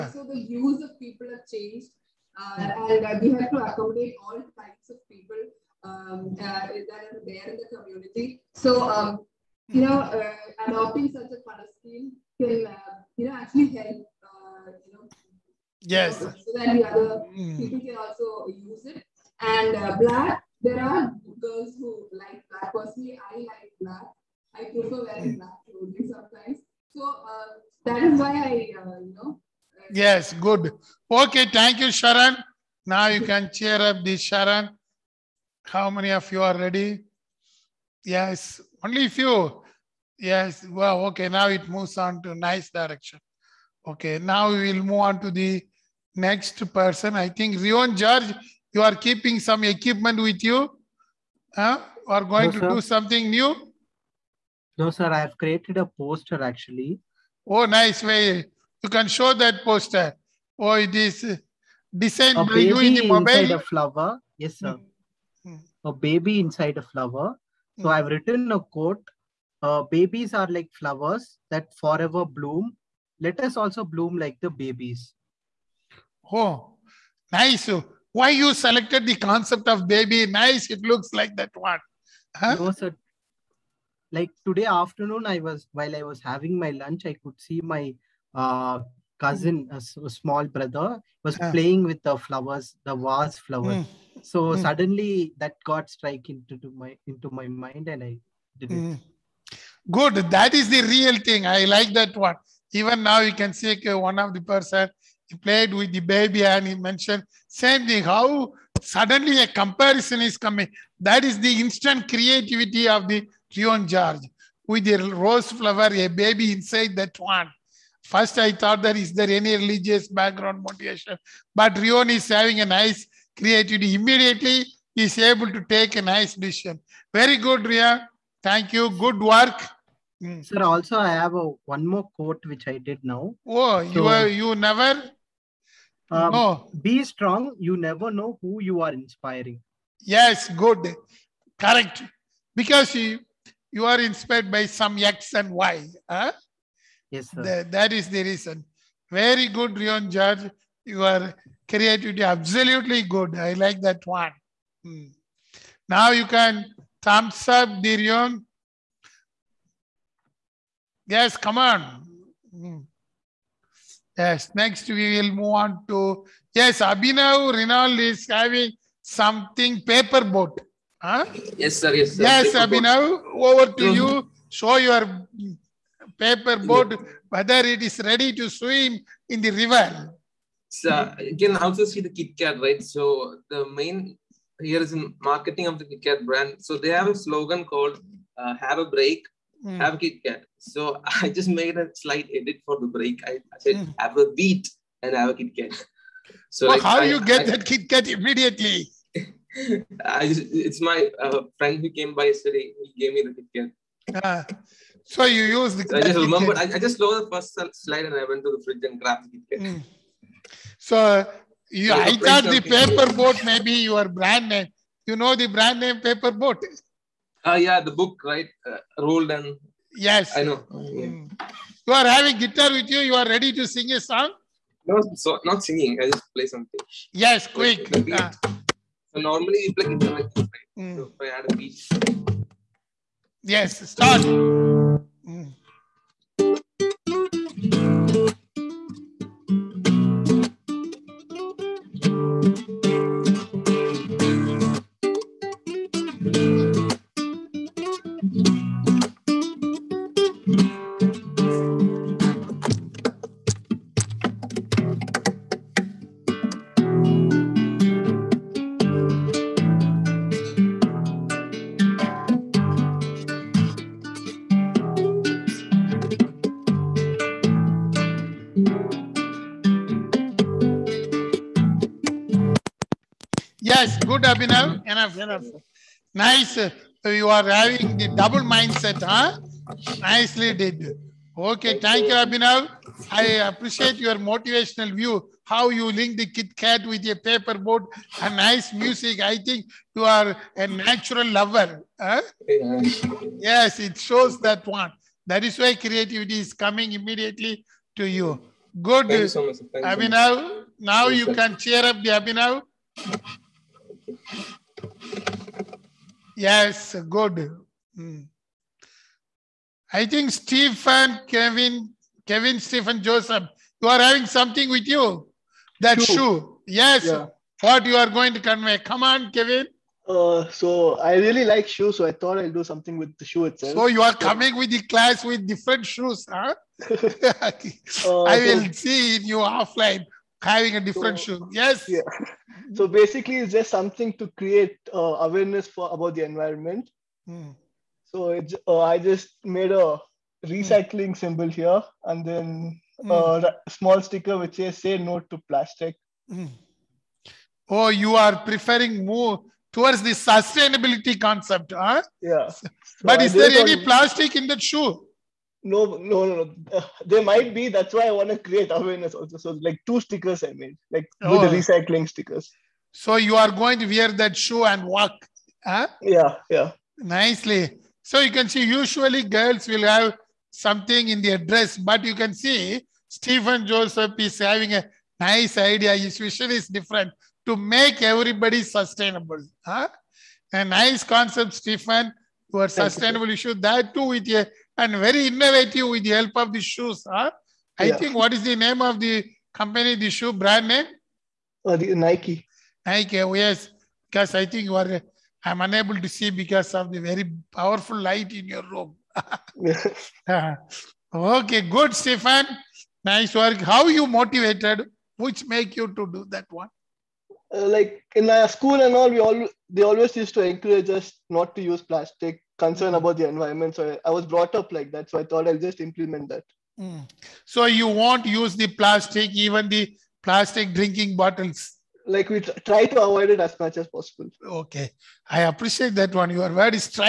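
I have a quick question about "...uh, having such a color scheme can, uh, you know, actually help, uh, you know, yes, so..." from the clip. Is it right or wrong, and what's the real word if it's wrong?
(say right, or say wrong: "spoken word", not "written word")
wrong: "adopting", not "having".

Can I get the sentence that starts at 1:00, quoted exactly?
Oh, it is designed a by you in the mobile.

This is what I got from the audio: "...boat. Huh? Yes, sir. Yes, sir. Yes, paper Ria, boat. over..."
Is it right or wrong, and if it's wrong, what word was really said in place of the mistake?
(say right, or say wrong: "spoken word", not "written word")
wrong: "Abhinav", not "Ria".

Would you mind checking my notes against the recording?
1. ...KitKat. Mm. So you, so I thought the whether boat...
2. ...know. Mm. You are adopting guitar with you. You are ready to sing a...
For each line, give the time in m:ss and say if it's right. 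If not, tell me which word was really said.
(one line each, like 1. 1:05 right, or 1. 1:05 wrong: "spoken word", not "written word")
1. 3:29 wrong: "paper", not "whether"
2. 3:40 wrong: "having", not "adopting".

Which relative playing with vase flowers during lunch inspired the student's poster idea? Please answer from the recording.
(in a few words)
Cousin.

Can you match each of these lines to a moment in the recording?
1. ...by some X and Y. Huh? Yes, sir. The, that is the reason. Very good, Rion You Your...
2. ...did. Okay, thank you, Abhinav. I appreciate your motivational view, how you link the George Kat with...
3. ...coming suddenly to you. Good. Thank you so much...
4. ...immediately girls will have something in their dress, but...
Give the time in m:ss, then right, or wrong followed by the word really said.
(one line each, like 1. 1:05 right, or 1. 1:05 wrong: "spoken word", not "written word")
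1. 2:24 right
2. 4:40 wrong: "Kit", not "George"
3. 4:56 wrong: "immediately", not "suddenly"
4. 6:08 wrong: "usually", not "immediately".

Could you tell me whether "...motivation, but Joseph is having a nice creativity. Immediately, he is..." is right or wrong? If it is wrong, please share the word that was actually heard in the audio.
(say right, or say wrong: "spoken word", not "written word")
wrong: "Rion", not "Joseph".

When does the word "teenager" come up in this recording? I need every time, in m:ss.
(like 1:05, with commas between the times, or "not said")
not said.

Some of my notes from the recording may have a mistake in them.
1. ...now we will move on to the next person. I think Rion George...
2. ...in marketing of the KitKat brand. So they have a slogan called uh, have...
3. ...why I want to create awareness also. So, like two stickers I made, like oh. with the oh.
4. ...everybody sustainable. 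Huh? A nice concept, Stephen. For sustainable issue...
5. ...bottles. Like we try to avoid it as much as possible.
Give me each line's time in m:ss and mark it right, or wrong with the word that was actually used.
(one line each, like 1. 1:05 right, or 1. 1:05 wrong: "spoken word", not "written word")
1. 0:44 right
2. 3:04 right
3. 5:57 right
4. 6:18 right
5. 7:01 right.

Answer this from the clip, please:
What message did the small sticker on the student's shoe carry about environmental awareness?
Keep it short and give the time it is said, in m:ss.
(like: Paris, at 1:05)
Say no to plastic, at 5:44.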